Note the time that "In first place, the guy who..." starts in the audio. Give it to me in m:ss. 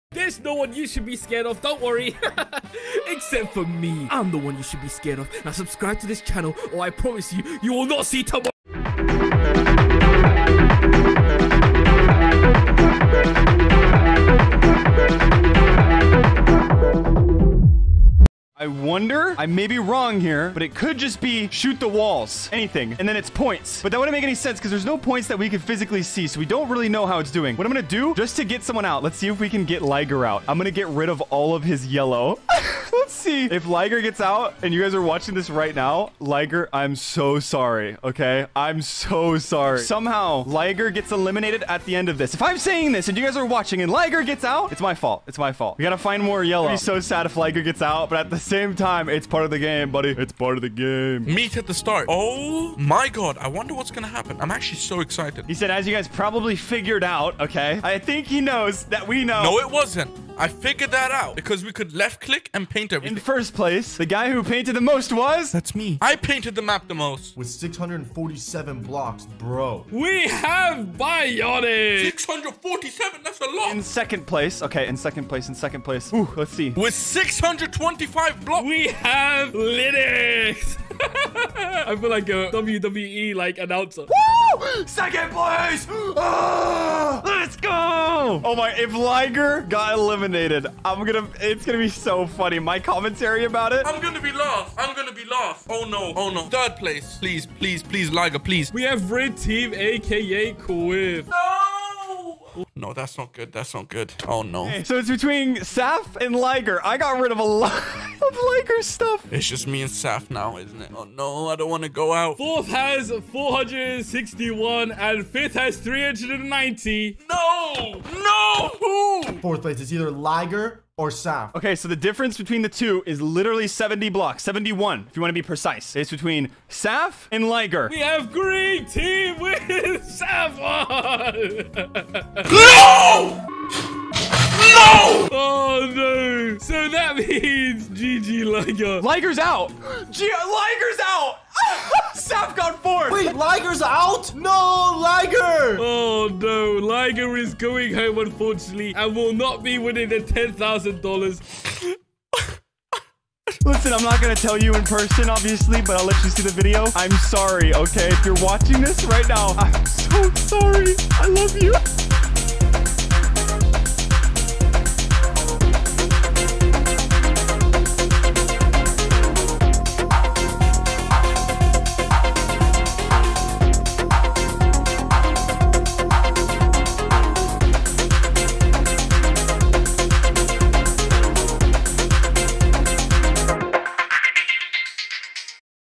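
1:03.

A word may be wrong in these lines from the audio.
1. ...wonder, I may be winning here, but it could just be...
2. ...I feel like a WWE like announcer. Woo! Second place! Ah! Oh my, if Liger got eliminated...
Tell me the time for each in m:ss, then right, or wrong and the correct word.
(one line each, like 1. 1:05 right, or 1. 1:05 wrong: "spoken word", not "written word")
1. 0:18 wrong: "wrong", not "winning"
2. 1:21 right.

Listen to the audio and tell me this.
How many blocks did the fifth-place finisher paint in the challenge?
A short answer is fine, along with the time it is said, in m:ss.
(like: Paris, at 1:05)
390, at 1:55.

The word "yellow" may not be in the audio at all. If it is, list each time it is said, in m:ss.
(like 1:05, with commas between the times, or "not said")
0:31, 0:46.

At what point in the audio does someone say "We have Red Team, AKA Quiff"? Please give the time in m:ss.
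1:38.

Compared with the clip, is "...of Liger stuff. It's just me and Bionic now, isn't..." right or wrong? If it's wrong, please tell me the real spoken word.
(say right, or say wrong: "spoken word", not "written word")
wrong: "Saf", not "Bionic".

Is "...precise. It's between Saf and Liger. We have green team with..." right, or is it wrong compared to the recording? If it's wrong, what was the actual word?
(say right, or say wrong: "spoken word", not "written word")
right.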